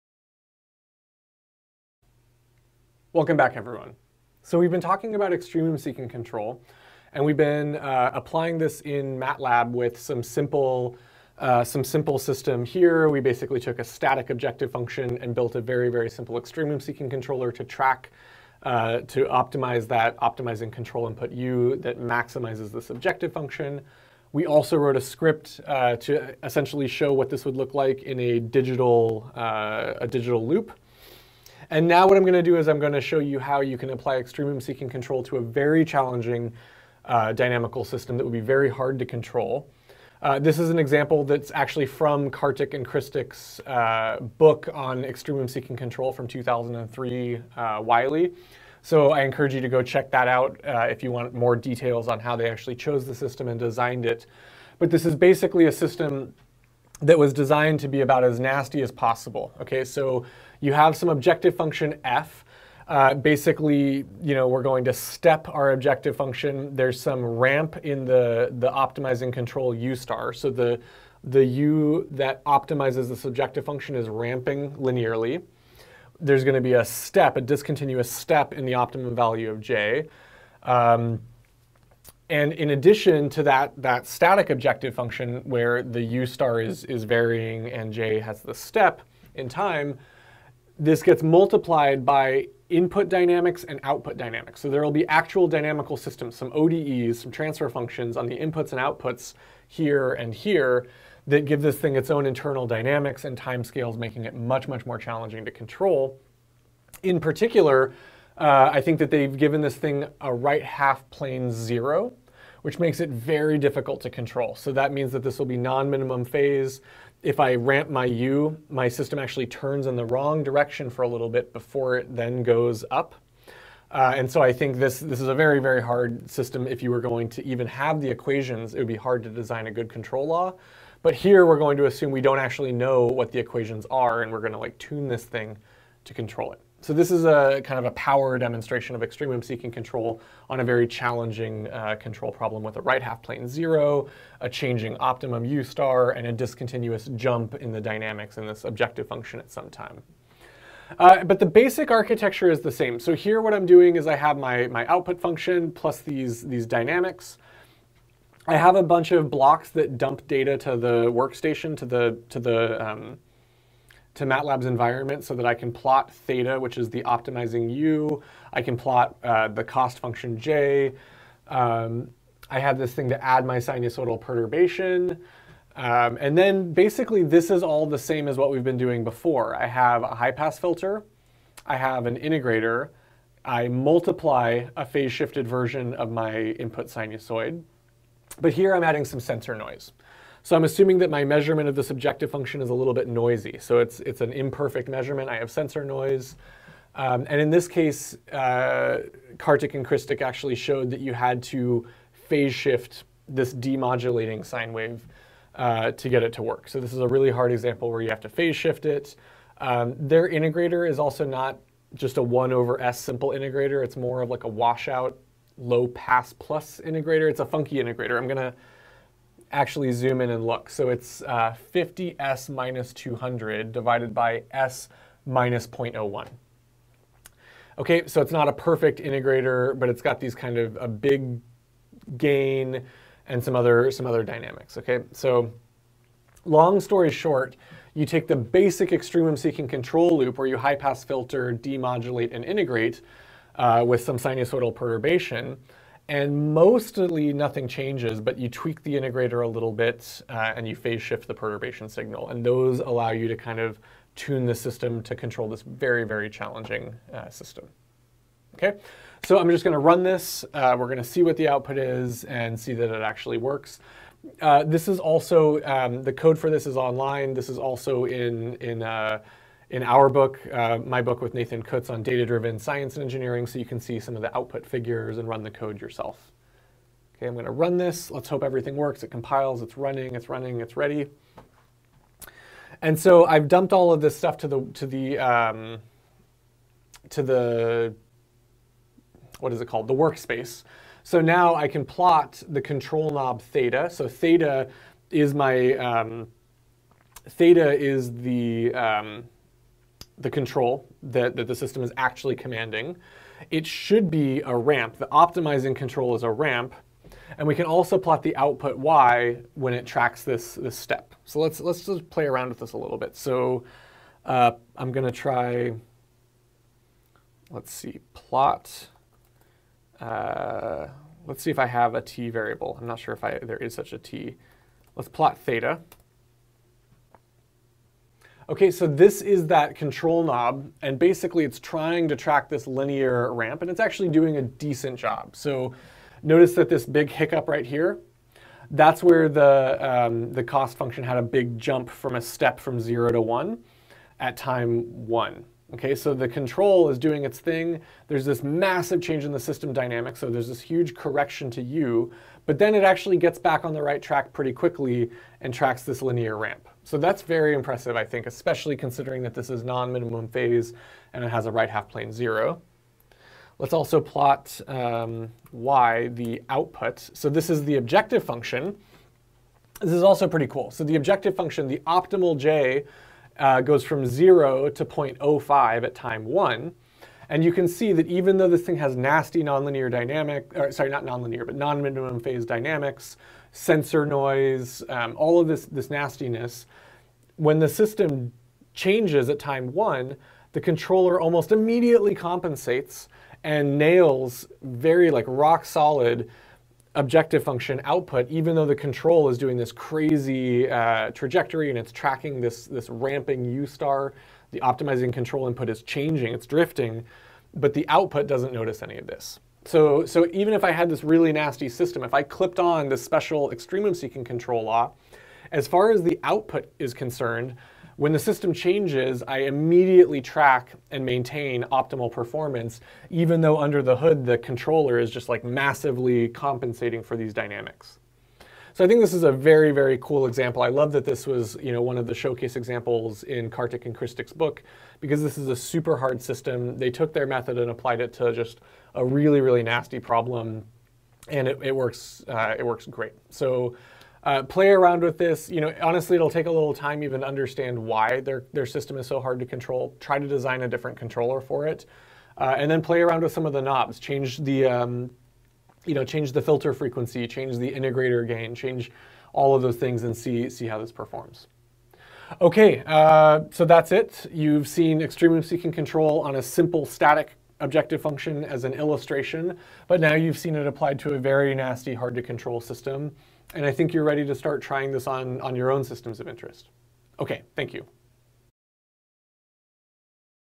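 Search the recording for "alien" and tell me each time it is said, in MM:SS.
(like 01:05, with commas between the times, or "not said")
not said.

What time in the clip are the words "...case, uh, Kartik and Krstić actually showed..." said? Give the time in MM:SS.
03:17.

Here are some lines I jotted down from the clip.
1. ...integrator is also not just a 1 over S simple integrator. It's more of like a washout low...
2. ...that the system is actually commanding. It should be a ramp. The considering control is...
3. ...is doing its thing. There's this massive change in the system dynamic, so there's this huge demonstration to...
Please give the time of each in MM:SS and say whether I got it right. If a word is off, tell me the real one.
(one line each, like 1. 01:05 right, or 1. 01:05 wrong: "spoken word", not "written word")
1. 03:30 right
2. 05:01 wrong: "optimizing", not "considering"
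3. 05:46 wrong: "correction", not "demonstration".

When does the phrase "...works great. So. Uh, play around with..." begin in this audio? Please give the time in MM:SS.
07:22.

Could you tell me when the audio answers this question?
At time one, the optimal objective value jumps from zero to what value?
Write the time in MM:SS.
06:14.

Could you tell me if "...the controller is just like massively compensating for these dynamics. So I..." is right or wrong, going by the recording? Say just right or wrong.
right.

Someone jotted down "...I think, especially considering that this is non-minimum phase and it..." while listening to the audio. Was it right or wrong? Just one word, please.
right.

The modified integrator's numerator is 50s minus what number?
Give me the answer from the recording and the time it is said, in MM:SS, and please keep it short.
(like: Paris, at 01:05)
200, at 03:42.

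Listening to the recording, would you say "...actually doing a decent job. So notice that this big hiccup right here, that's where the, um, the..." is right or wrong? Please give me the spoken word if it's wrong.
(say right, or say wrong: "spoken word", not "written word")
right.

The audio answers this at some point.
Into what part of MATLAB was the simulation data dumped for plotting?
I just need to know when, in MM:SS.
04:49.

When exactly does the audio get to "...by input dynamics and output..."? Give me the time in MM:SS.
01:32.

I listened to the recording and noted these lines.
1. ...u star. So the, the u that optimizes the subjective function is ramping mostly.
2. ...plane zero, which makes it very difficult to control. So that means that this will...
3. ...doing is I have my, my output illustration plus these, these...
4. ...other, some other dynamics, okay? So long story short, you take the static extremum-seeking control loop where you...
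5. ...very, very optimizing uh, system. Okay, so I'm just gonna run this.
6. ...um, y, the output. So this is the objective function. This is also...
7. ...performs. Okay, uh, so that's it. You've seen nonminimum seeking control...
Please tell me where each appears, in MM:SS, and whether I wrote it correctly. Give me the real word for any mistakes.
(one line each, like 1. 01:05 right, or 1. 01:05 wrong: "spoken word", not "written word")
1. 01:09 wrong: "linearly", not "mostly"
2. 01:51 right
3. 02:33 wrong: "function", not "illustration"
4. 03:53 wrong: "basic", not "static"
5. 04:15 wrong: "challenging", not "optimizing"
6. 06:04 right
7. 07:40 wrong: "extremum", not "nonminimum".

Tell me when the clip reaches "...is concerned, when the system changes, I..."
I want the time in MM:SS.
06:56.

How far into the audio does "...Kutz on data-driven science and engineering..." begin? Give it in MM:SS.
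04:31.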